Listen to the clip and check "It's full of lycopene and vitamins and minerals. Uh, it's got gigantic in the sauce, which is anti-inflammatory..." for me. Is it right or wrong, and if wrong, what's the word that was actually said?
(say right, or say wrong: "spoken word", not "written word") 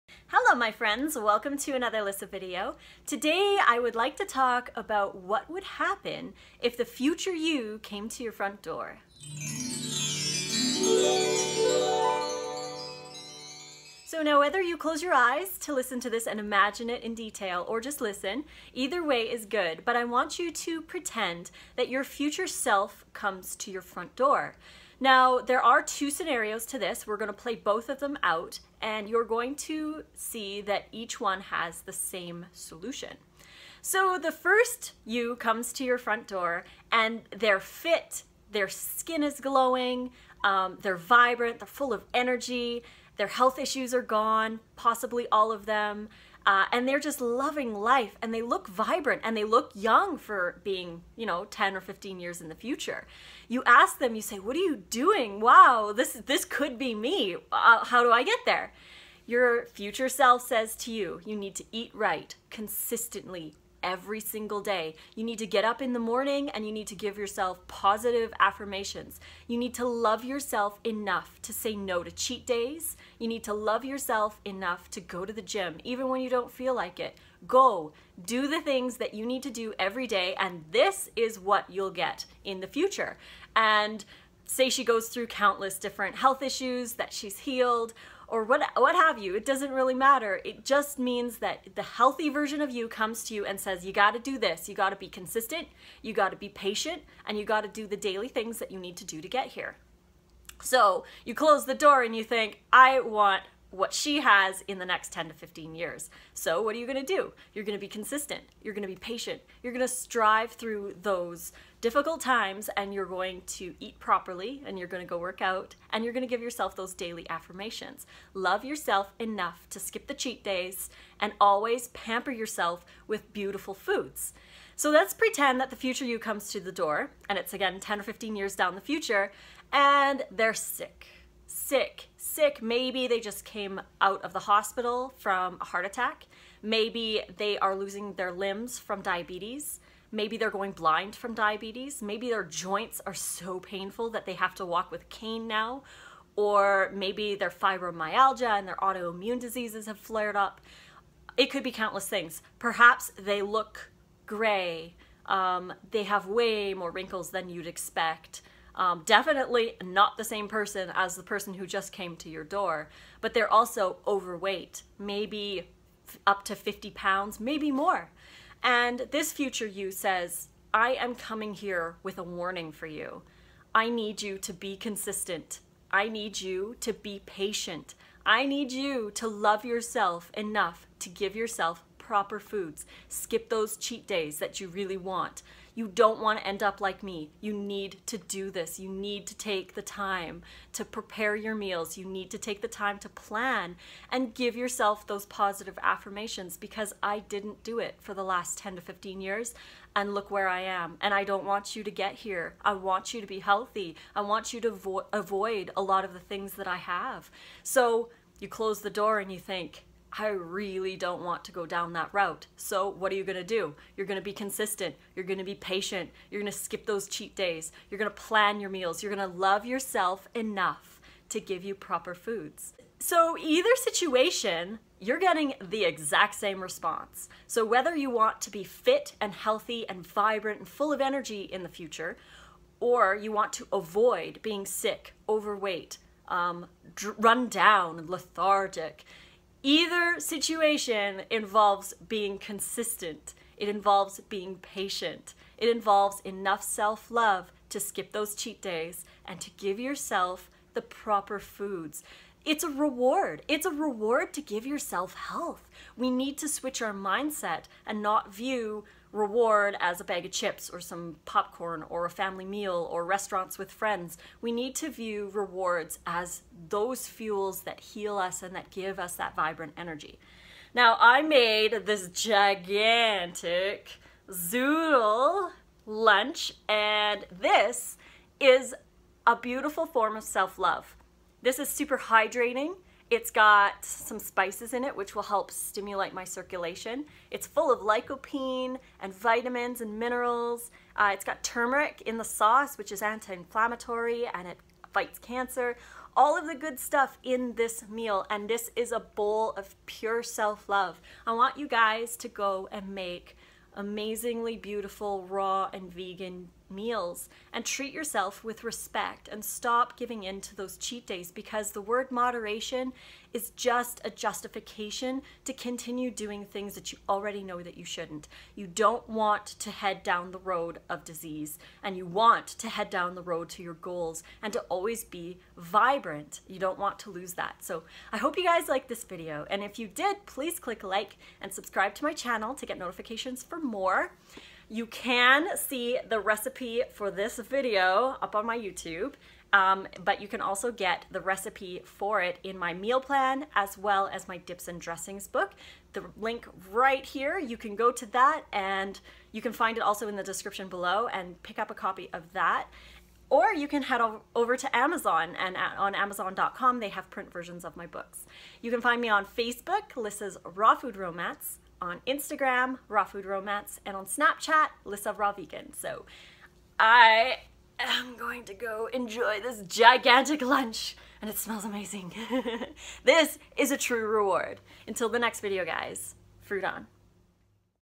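wrong: "turmeric", not "gigantic".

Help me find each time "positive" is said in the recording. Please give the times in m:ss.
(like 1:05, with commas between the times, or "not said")
1:07, 3:15.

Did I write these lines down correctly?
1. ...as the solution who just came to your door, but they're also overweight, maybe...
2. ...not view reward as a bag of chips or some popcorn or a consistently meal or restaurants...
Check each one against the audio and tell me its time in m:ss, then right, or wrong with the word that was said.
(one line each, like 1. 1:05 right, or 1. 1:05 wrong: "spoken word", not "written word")
1. 2:40 wrong: "person", not "solution"
2. 4:18 wrong: "family", not "consistently".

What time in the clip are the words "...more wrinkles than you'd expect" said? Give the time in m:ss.
2:36.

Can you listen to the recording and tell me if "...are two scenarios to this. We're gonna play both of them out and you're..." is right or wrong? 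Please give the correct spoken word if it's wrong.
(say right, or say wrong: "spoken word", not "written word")
right.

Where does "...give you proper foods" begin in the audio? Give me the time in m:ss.
3:41.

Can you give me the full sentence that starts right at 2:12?
Maybe they just came out of the hospital from a heart attack.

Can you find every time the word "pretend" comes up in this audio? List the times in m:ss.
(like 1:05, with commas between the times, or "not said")
0:20, 2:05.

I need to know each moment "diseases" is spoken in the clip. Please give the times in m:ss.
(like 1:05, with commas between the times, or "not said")
2:29, 5:21.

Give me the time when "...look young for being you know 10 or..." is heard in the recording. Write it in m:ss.
0:49.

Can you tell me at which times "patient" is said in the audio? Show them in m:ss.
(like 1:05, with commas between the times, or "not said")
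1:36, 1:48, 2:57, 3:35, 4:04.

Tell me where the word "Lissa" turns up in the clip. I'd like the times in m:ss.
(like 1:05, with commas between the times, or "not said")
0:02, 5:59, 6:04.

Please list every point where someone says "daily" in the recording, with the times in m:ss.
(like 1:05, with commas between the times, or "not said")
1:37, 1:56.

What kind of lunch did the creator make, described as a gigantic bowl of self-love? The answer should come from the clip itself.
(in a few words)
Zoodle lunch.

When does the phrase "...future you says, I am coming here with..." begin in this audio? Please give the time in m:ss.
2:49.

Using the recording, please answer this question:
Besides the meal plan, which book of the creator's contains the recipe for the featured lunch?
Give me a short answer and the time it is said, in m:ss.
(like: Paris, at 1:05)
Dips and dressings book, at 5:44.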